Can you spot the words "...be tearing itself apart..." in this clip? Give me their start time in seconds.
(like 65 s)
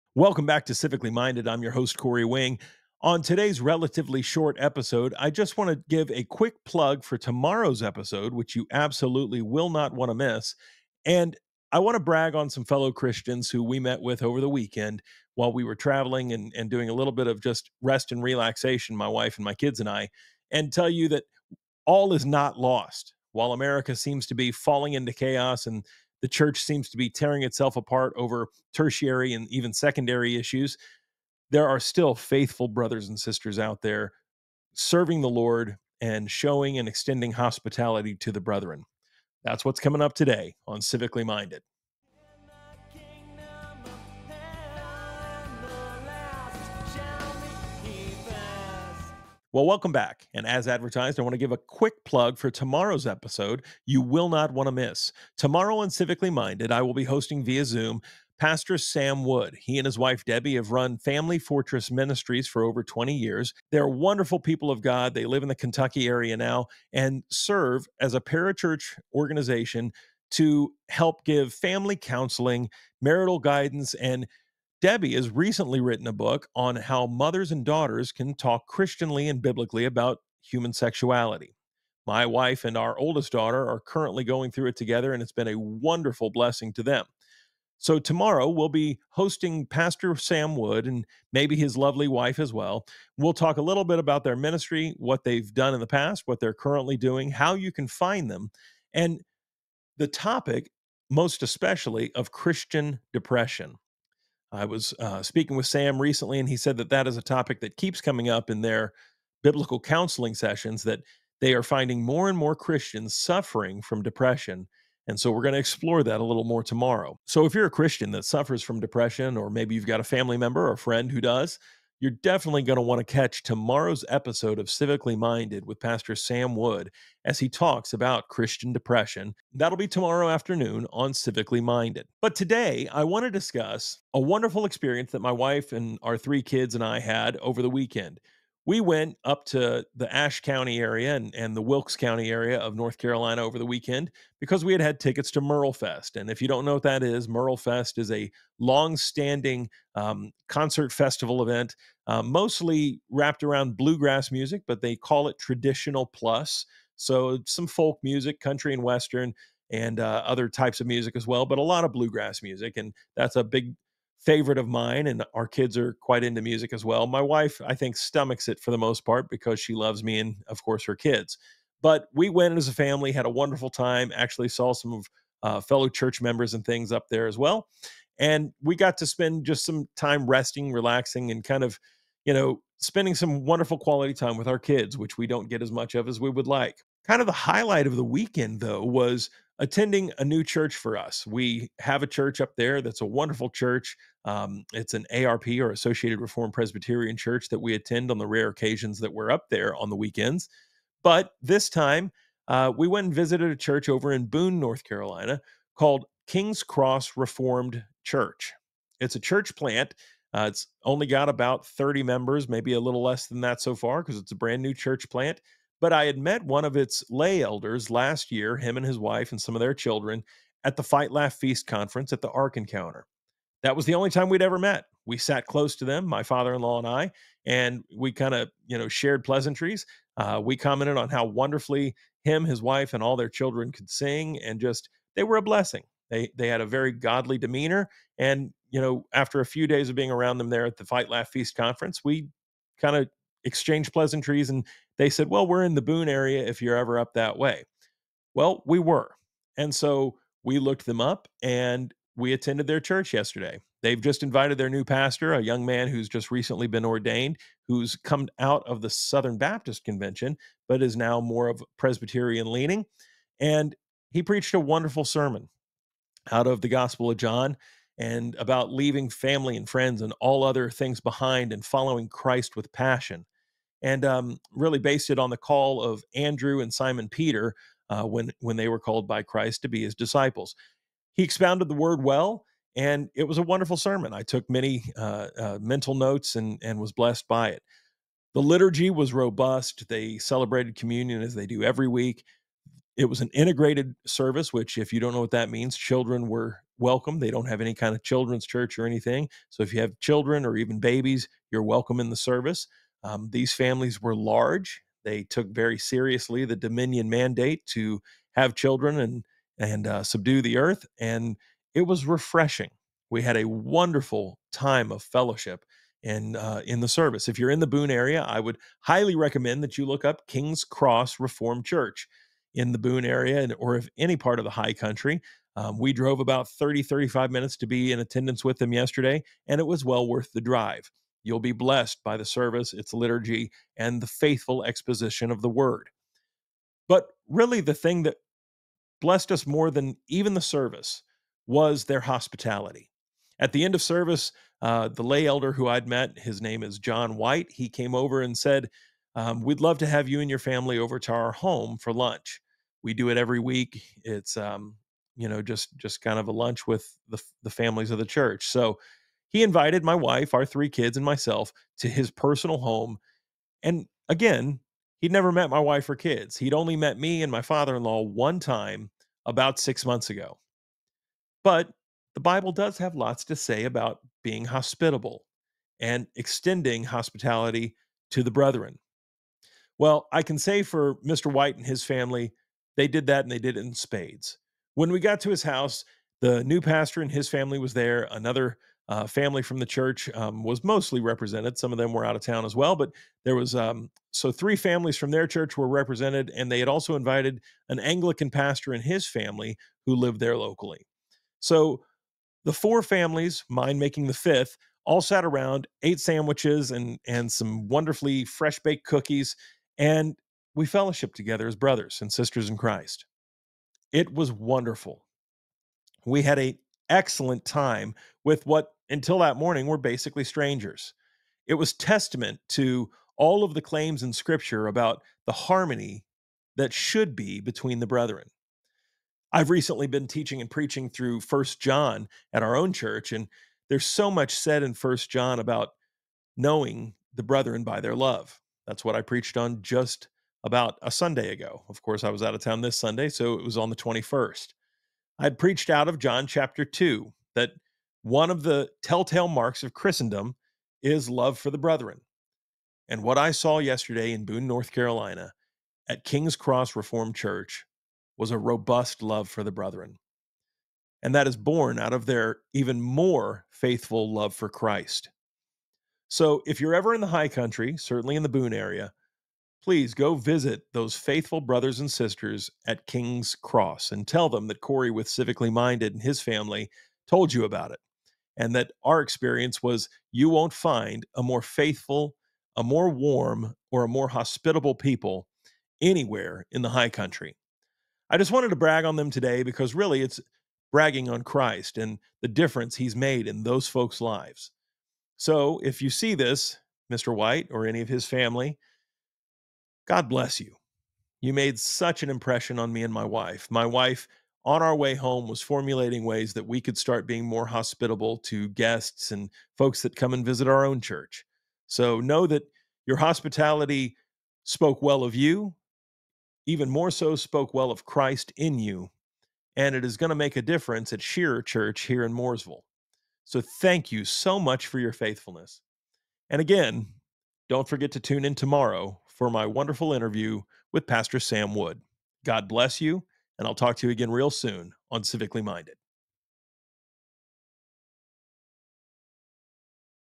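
26 s.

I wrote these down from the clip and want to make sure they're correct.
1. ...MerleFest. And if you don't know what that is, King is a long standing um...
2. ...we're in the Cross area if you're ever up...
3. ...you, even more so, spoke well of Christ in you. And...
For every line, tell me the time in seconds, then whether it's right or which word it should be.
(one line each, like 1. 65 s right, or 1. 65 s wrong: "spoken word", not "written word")
1. 145 s wrong: "MerleFest", not "King"
2. 245 s wrong: "Boone", not "Cross"
3. 515 s right.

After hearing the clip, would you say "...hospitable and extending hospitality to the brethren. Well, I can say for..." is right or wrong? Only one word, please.
right.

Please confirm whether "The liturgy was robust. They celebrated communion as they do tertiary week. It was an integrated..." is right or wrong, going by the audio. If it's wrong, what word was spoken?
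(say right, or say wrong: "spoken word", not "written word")
wrong: "every", not "tertiary".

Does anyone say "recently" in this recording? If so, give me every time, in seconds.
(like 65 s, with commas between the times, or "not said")
75 s, 106 s, 256 s, 429 s.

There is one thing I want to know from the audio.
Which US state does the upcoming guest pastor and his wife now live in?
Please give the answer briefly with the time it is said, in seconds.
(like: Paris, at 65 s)
Kentucky, at 65 s.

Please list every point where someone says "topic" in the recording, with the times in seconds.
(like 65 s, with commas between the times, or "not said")
100 s, 107 s.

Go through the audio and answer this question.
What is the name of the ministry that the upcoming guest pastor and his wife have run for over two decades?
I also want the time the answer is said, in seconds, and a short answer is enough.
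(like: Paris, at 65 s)
Family Fortress Ministries, at 60 s.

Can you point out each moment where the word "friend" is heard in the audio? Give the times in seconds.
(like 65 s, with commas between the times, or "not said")
120 s, 269 s.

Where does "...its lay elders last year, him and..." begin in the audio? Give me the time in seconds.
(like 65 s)
216 s.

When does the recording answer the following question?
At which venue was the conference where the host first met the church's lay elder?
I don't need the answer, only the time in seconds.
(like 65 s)
222 s.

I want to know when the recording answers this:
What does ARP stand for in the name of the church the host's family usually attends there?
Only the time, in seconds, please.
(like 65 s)
195 s.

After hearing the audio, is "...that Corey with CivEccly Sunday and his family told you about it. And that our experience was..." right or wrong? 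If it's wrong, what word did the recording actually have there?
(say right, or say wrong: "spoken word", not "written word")
wrong: "Minded", not "Sunday".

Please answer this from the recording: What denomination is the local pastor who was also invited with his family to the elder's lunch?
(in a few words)
Anglican.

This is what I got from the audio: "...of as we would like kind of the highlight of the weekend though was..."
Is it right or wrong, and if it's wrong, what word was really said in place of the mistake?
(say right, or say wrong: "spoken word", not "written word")
right.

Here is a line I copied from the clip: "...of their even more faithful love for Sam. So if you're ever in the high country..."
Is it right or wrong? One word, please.
wrong.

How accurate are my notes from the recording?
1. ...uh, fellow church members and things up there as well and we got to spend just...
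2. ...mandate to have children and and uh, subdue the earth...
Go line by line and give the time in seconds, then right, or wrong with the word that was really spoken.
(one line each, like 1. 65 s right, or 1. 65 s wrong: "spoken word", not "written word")
1. 175 s right
2. 307 s right.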